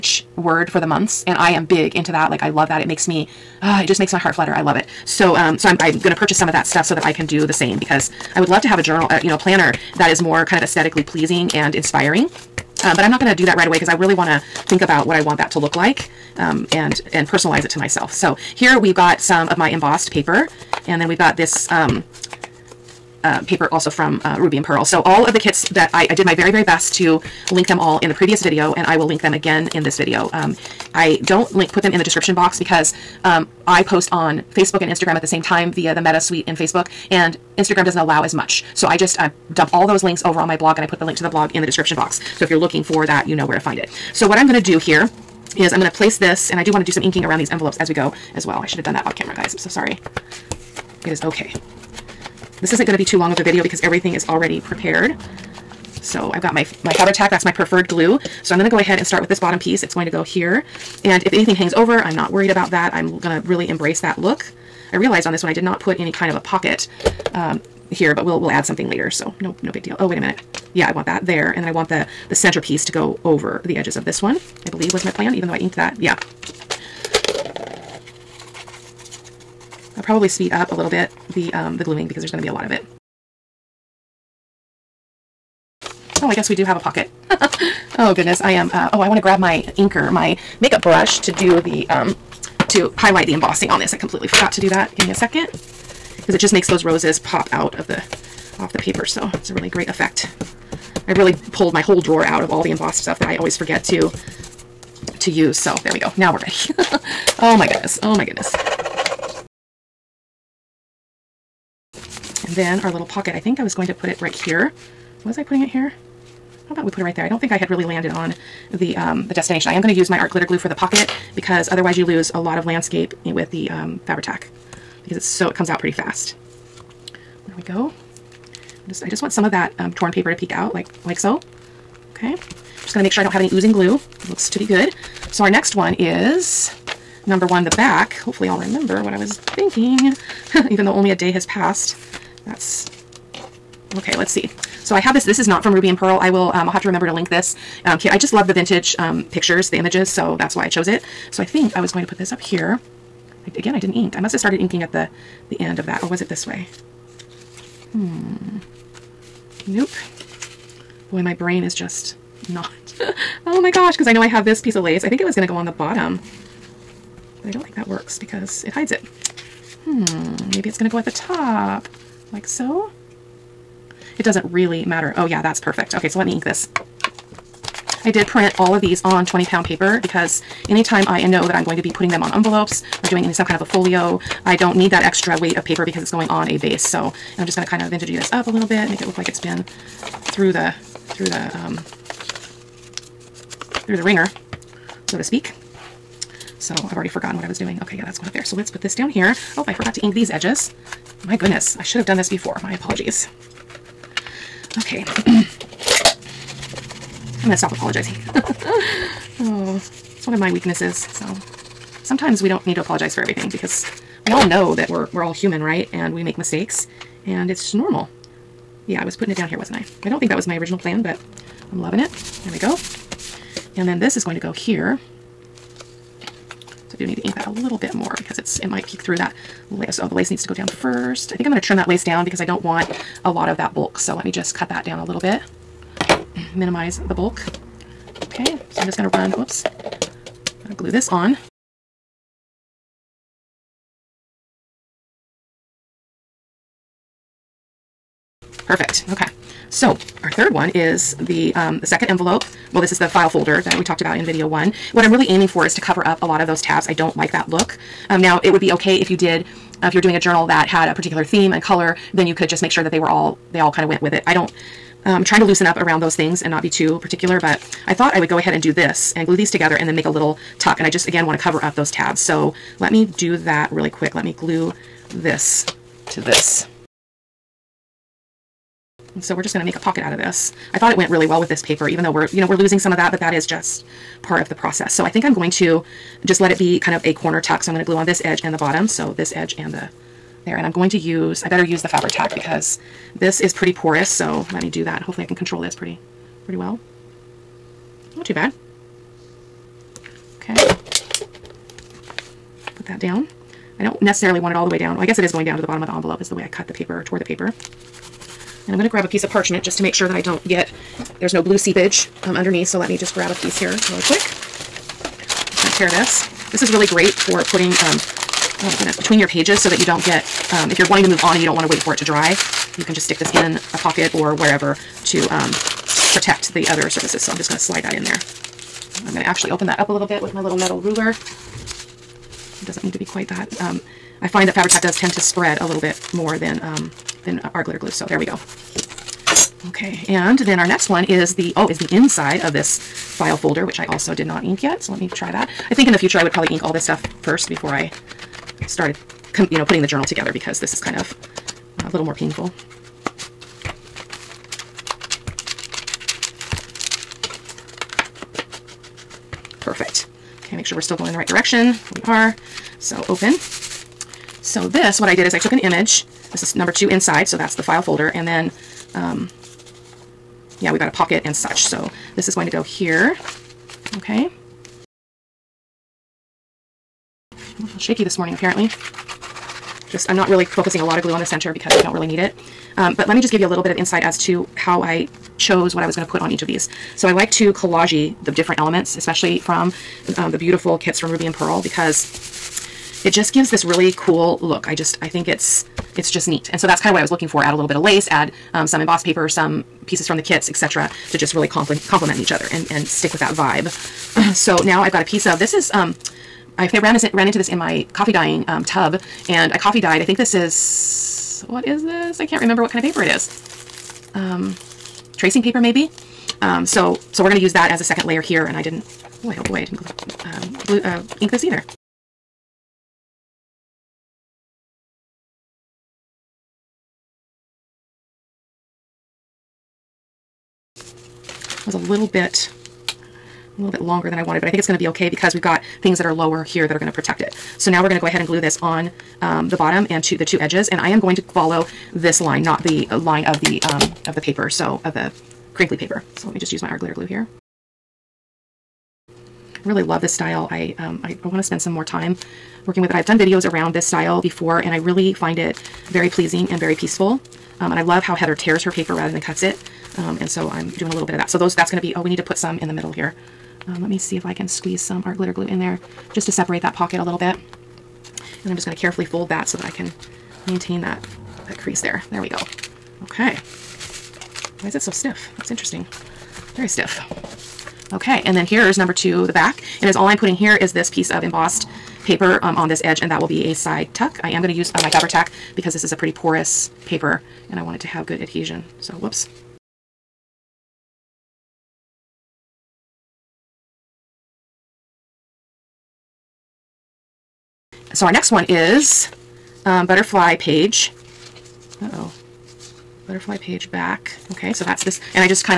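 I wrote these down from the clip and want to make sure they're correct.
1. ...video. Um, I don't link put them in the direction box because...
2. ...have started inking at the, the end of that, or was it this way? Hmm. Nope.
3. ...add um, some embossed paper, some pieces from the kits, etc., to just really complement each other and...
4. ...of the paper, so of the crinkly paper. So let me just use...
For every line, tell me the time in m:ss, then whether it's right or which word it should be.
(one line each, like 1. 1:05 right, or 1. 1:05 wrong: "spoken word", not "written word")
1. 0:29 wrong: "description", not "direction"
2. 2:34 right
3. 6:38 right
4. 7:24 right.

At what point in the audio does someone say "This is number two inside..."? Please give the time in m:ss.
6:06.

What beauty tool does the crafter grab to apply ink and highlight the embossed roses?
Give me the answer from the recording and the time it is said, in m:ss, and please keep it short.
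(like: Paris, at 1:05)
makeup brush, at 1:30.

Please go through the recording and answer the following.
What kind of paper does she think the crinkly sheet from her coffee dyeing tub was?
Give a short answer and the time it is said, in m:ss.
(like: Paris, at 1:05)
tracing paper, at 6:55.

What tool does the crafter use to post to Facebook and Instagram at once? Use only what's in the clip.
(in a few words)
Meta Suite.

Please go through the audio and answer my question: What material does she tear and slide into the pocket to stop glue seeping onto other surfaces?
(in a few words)
parchment.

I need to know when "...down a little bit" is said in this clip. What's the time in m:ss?
3:54.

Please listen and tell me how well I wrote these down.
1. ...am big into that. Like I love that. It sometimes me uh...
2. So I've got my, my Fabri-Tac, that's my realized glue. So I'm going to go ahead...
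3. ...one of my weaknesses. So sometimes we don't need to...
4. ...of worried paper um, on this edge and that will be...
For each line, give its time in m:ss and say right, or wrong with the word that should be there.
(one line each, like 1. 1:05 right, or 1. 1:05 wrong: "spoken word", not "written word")
1. 0:01 wrong: "makes", not "sometimes"
2. 0:56 wrong: "preferred", not "realized"
3. 3:30 right
4. 8:01 wrong: "embossed", not "worried".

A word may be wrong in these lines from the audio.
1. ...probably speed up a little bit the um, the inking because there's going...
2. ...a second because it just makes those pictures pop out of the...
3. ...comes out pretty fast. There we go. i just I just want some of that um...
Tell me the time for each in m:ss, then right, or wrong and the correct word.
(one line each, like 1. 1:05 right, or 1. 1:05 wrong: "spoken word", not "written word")
1. 1:20 wrong: "gluing", not "inking"
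2. 1:35 wrong: "roses", not "pictures"
3. 2:05 right.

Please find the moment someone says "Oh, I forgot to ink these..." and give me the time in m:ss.
3:19.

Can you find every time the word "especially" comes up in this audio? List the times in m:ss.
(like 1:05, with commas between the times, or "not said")
6:28.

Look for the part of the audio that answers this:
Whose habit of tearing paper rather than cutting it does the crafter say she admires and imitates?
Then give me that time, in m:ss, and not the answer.
7:38.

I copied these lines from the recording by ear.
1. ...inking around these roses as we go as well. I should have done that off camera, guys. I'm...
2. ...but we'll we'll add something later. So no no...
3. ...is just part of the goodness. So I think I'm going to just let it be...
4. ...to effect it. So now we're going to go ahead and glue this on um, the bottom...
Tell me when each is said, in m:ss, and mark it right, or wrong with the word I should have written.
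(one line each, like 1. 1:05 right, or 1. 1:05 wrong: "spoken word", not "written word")
1. 0:47 wrong: "envelopes", not "roses"
2. 1:08 right
3. 4:43 wrong: "process", not "goodness"
4. 7:16 wrong: "protect", not "effect".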